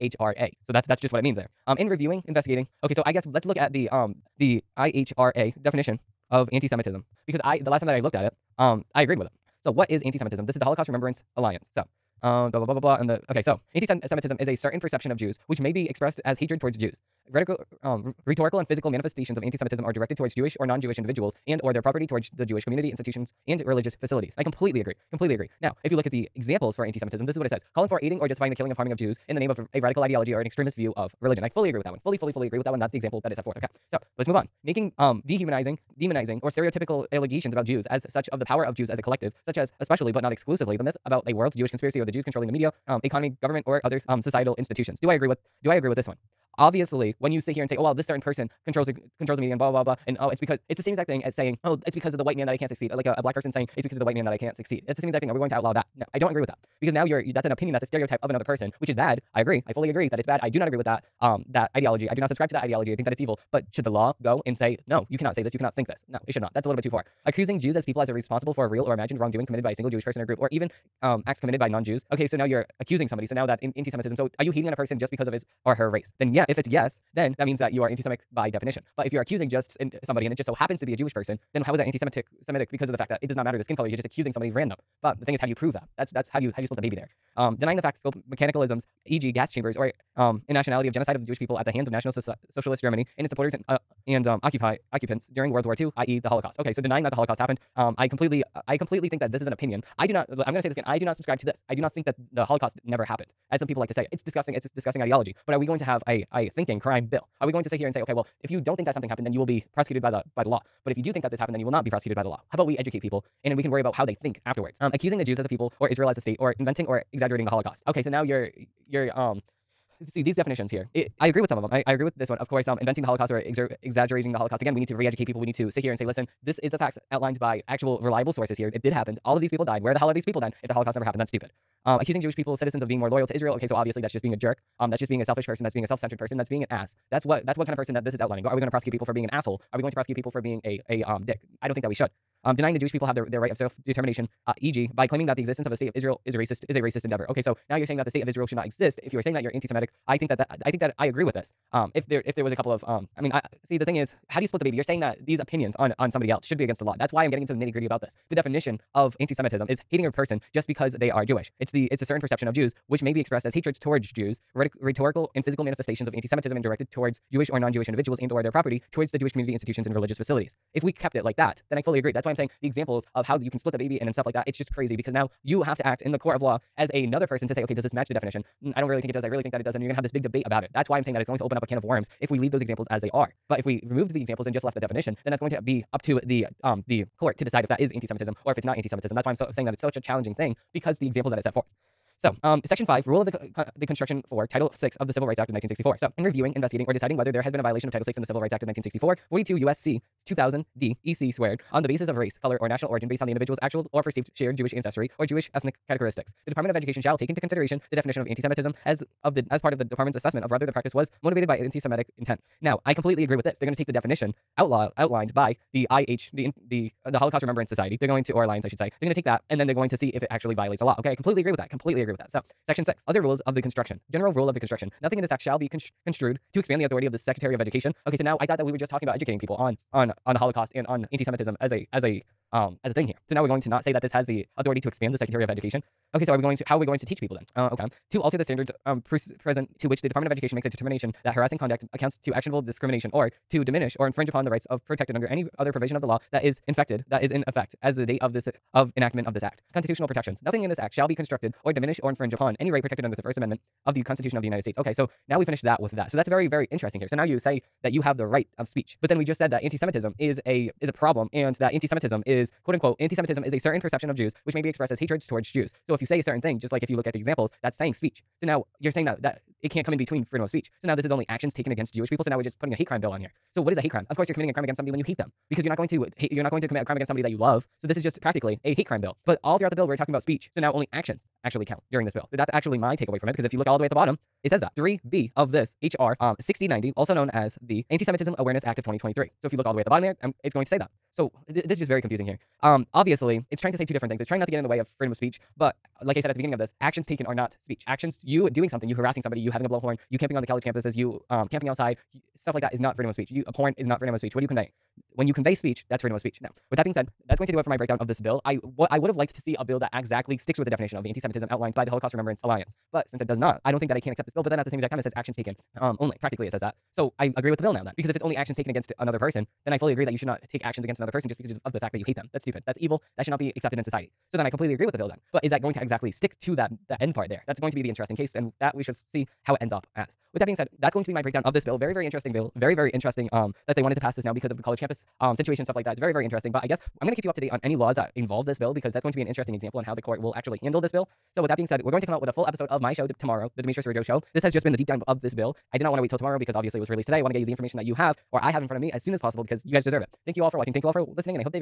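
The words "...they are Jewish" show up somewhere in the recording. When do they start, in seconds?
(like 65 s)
160 s.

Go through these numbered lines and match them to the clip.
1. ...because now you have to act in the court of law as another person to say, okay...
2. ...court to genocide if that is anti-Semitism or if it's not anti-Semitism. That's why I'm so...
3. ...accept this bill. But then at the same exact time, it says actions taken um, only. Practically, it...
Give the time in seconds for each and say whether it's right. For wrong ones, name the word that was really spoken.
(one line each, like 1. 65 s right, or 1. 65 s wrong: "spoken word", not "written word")
1. 174 s right
2. 187 s wrong: "decide", not "genocide"
3. 314 s right.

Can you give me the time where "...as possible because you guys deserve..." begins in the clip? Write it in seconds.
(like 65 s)
349 s.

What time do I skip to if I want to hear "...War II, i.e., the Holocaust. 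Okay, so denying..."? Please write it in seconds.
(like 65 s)
95 s.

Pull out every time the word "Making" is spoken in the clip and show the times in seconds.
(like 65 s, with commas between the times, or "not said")
34 s.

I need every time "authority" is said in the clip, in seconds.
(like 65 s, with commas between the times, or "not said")
226 s, 234 s.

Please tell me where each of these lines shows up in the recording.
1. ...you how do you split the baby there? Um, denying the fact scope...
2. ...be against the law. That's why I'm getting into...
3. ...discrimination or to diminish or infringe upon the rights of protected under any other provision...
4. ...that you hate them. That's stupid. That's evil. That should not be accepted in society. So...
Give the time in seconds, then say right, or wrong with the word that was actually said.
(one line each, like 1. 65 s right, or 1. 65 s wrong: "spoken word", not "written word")
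1. 86 s right
2. 156 s right
3. 242 s right
4. 321 s right.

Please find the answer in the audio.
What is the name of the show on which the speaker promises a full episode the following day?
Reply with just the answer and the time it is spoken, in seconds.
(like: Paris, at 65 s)
The Demetrios Araujo Show, at 343 s.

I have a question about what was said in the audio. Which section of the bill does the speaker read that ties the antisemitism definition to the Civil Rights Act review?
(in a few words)
Section 5.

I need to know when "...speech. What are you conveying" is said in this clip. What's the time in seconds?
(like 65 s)
304 s.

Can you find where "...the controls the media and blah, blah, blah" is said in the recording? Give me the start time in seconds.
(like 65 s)
48 s.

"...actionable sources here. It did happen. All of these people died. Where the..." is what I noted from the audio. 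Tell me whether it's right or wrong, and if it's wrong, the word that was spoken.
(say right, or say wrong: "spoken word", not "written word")
wrong: "reliable", not "actionable".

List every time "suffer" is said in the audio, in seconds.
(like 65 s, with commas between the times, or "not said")
not said.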